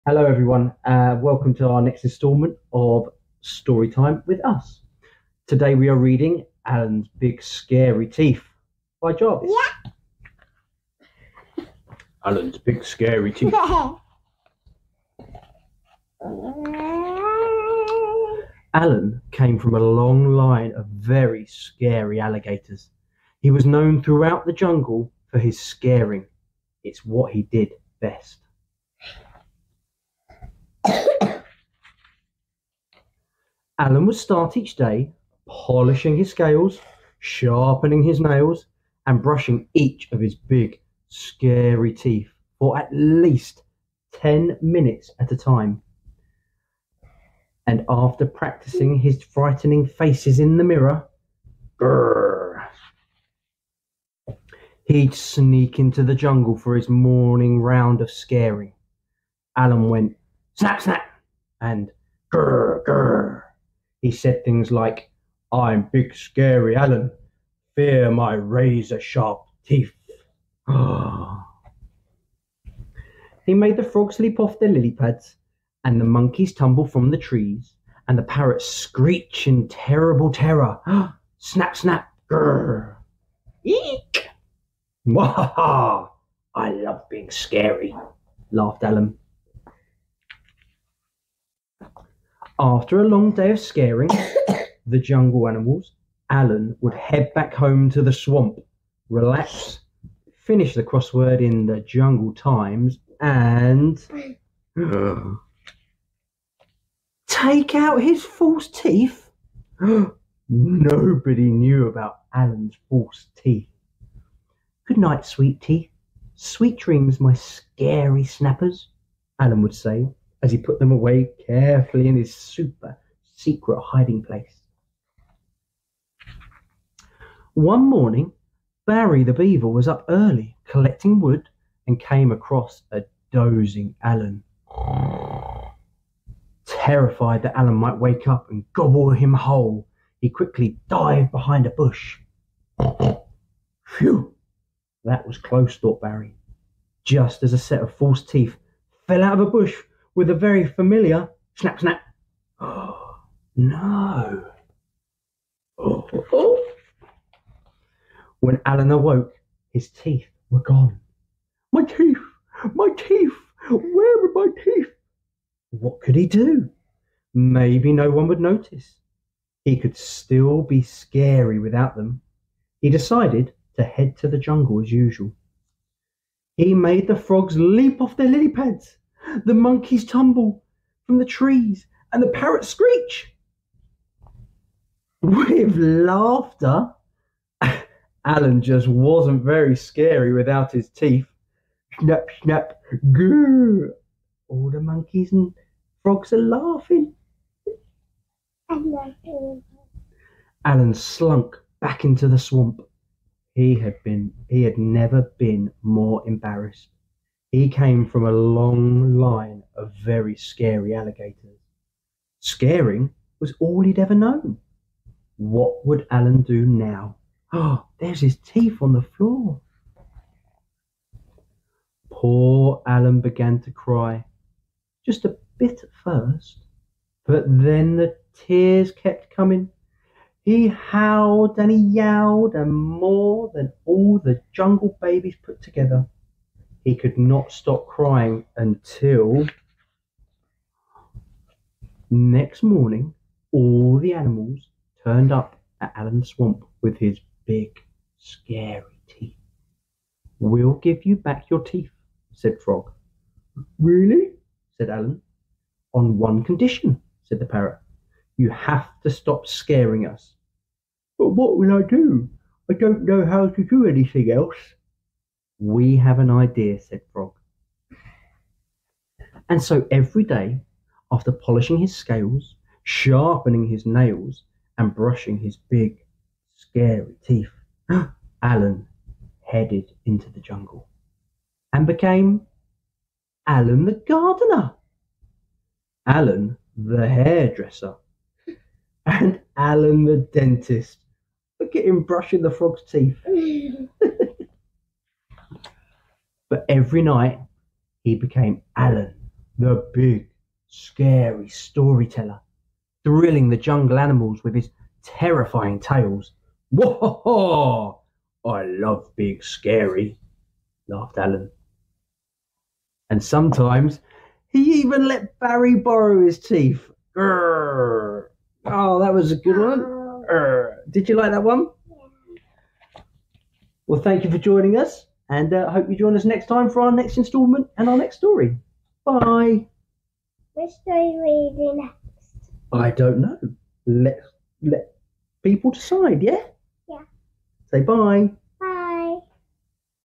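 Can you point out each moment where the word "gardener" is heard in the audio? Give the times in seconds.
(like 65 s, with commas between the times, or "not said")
284 s.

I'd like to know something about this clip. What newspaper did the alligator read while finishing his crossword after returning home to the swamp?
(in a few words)
The Jungle Times.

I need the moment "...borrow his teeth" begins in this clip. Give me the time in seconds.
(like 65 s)
315 s.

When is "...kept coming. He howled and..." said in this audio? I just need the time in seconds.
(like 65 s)
228 s.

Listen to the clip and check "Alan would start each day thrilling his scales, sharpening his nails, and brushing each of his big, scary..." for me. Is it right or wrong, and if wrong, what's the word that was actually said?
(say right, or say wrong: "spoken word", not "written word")
wrong: "polishing", not "thrilling".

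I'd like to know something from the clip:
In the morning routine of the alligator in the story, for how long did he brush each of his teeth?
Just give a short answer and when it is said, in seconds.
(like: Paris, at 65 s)
10 minutes, at 44 s.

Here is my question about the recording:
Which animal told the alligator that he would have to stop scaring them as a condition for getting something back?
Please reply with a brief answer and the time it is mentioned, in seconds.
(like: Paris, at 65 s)
The parrot, at 257 s.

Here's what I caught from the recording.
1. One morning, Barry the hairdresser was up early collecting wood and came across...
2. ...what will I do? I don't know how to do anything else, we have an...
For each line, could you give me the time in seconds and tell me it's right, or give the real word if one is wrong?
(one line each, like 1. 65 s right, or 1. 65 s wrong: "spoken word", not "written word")
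1. 127 s wrong: "beaver", not "hairdresser"
2. 261 s right.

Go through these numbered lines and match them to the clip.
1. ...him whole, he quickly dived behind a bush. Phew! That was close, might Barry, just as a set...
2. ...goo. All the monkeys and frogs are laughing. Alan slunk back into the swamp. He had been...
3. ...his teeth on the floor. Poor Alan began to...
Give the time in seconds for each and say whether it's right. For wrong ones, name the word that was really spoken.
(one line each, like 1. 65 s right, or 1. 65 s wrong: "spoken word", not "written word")
1. 139 s wrong: "thought", not "might"
2. 193 s right
3. 218 s right.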